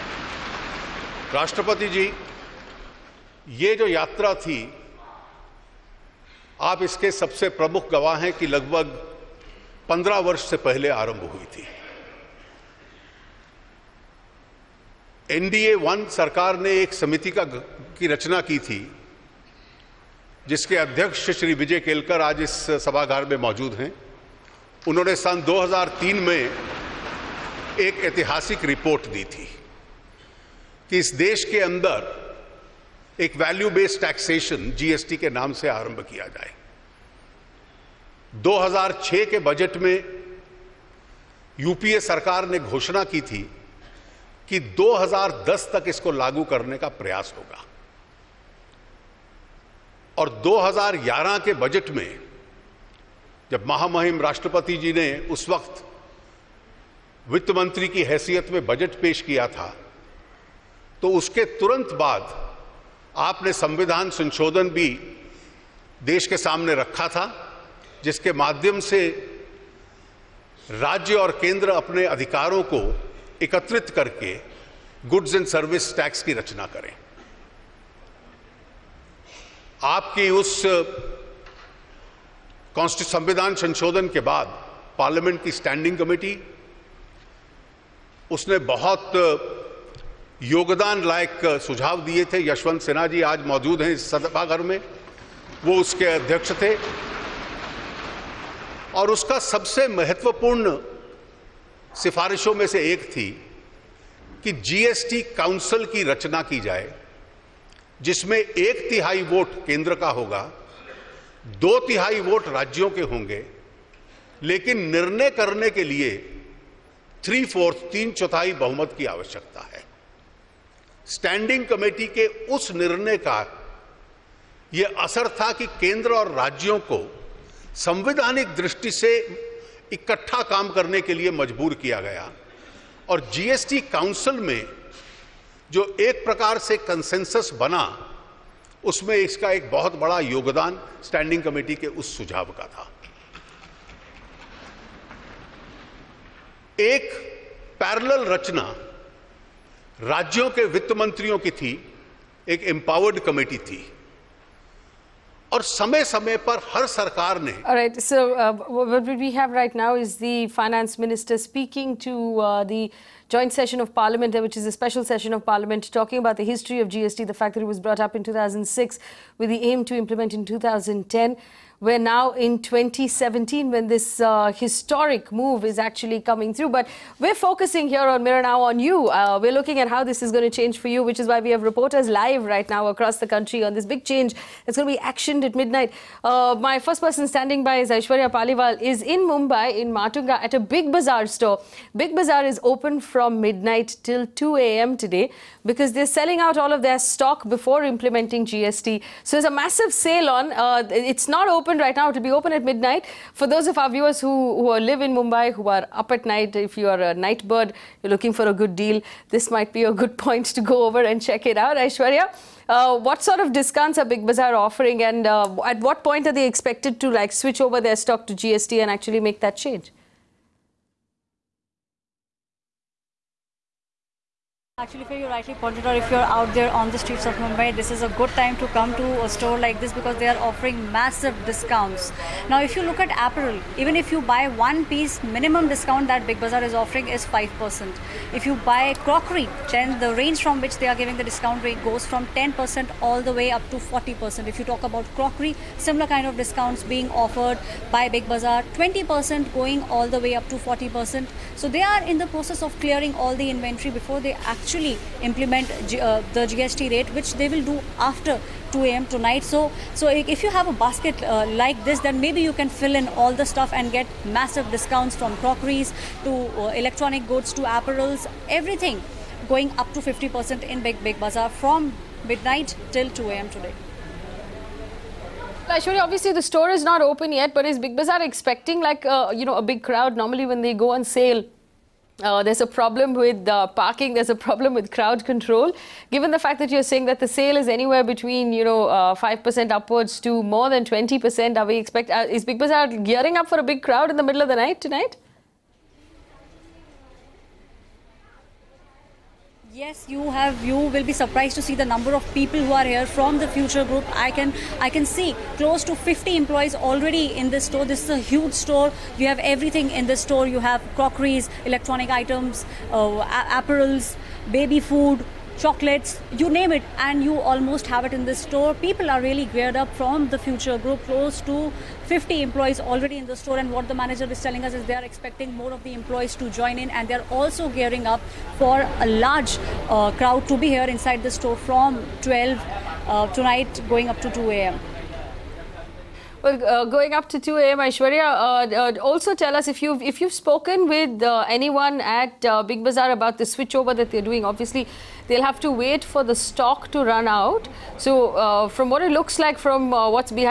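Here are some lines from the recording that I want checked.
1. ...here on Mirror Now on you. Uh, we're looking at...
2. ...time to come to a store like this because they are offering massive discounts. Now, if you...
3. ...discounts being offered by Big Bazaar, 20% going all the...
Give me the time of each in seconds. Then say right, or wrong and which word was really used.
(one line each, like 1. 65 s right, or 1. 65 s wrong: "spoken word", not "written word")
1. 177 s right
2. 228 s right
3. 246 s right.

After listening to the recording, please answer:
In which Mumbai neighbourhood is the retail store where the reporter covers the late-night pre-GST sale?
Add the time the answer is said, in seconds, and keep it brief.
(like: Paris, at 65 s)
Matunga, at 189 s.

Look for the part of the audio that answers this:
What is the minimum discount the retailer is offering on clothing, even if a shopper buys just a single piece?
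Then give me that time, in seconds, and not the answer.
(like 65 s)
237 s.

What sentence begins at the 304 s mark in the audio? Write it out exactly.
I can I can see close to 50 employees already in this store.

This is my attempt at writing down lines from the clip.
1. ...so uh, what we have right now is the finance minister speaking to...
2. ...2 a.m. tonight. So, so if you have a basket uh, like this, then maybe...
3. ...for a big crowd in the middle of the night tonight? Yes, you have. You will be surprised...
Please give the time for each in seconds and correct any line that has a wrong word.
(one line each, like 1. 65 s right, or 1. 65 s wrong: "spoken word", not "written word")
1. 158 s right
2. 258 s right
3. 293 s right.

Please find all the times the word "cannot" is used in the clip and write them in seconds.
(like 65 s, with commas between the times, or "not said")
not said.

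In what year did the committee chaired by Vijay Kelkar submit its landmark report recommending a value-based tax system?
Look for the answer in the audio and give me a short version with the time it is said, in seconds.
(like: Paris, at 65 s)
2003, at 25 s.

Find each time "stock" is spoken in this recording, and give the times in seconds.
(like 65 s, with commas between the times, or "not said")
196 s, 217 s, 346 s.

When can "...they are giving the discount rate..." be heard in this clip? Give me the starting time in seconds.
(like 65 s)
240 s.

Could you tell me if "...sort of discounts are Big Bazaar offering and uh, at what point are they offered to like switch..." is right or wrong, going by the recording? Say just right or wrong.
wrong.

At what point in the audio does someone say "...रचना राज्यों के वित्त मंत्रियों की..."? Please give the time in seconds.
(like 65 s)
148 s.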